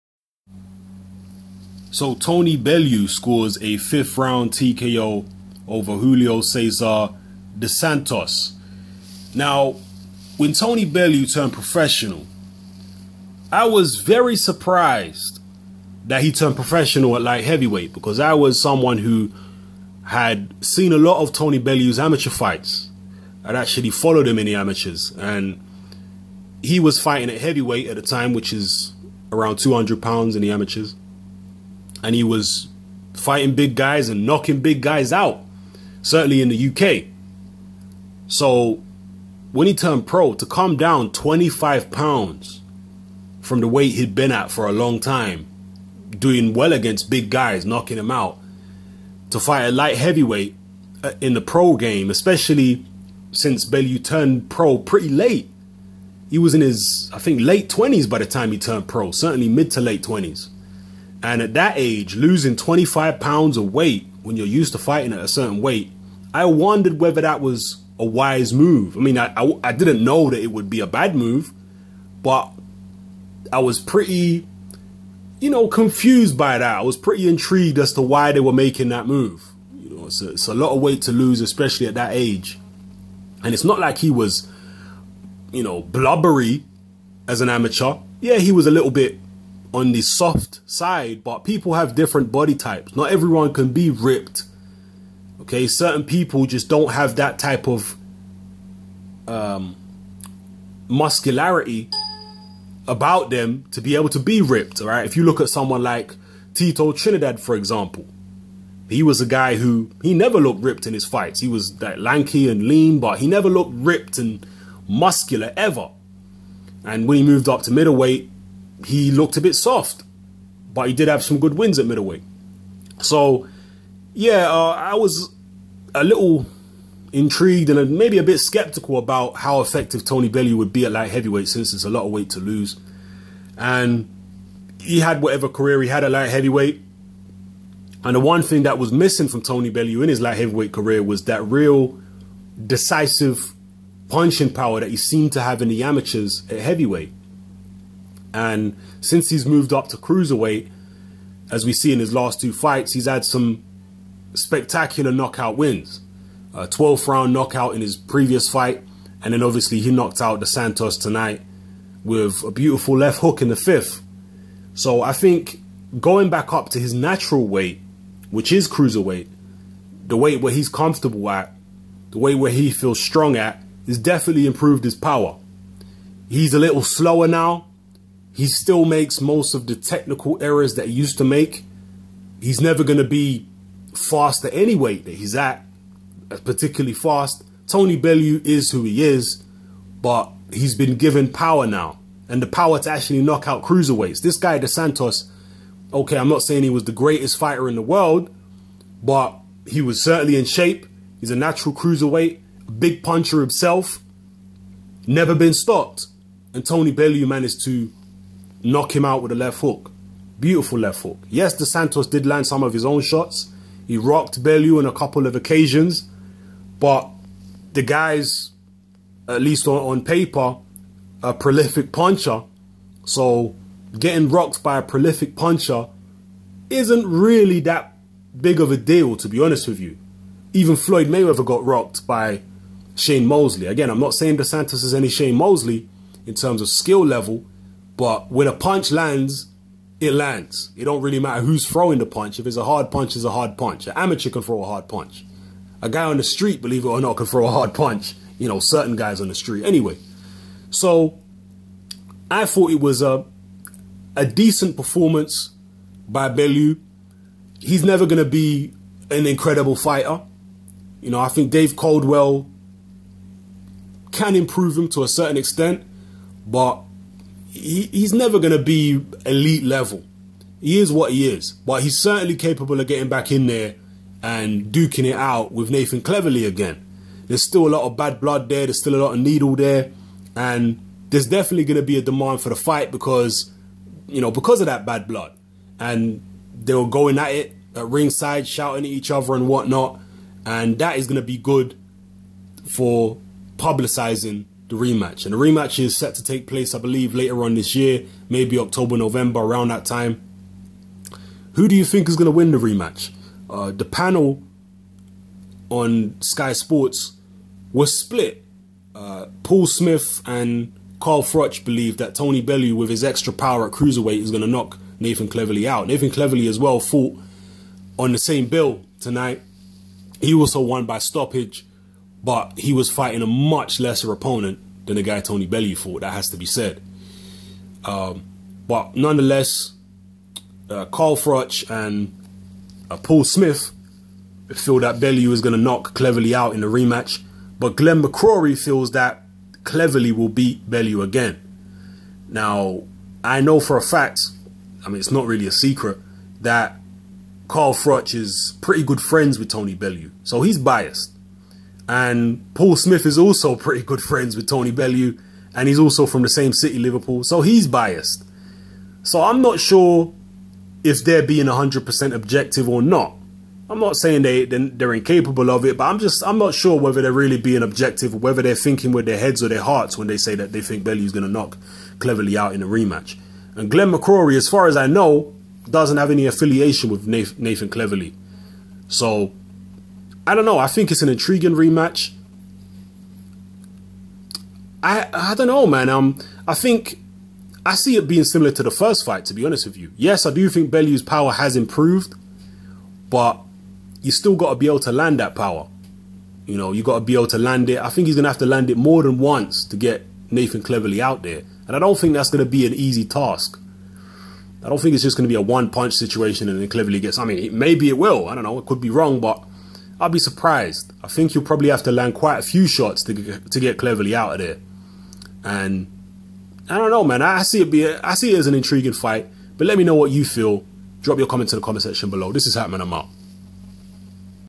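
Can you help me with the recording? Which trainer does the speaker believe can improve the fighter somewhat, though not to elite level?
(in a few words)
Dave Coldwell.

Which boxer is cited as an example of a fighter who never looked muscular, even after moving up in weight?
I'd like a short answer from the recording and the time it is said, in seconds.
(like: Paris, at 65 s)
Tito Trinidad, at 106 s.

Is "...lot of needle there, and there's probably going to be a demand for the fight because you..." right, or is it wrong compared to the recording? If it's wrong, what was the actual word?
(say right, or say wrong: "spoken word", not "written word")
wrong: "definitely", not "probably".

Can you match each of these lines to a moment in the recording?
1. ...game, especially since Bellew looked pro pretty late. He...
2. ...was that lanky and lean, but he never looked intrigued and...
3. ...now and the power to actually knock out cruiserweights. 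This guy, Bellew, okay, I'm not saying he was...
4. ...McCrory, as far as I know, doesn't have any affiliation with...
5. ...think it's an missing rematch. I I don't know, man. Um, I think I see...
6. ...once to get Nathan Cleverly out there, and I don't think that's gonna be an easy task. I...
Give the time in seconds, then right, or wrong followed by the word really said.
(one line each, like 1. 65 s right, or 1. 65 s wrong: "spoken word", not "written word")
1. 51 s wrong: "turned", not "looked"
2. 111 s wrong: "ripped", not "intrigued"
3. 191 s wrong: "DeSantos", not "Bellew"
4. 373 s right
5. 380 s wrong: "intriguing", not "missing"
6. 399 s right.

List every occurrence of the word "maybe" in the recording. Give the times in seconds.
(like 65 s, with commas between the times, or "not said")
127 s, 298 s, 407 s.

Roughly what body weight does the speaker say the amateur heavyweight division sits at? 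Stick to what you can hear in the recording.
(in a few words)
200 pounds.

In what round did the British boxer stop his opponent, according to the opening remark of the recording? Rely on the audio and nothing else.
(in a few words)
5th round.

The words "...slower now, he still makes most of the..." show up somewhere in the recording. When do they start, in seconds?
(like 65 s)
176 s.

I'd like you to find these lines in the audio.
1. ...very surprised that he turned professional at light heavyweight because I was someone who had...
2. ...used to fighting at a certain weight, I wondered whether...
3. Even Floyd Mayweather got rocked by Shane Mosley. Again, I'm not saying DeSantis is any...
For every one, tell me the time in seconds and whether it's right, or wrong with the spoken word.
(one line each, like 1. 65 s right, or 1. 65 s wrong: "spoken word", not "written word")
1. 13 s right
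2. 64 s right
3. 230 s right.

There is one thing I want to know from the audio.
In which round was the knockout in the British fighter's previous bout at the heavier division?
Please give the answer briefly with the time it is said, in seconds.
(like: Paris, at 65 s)
12th round, at 156 s.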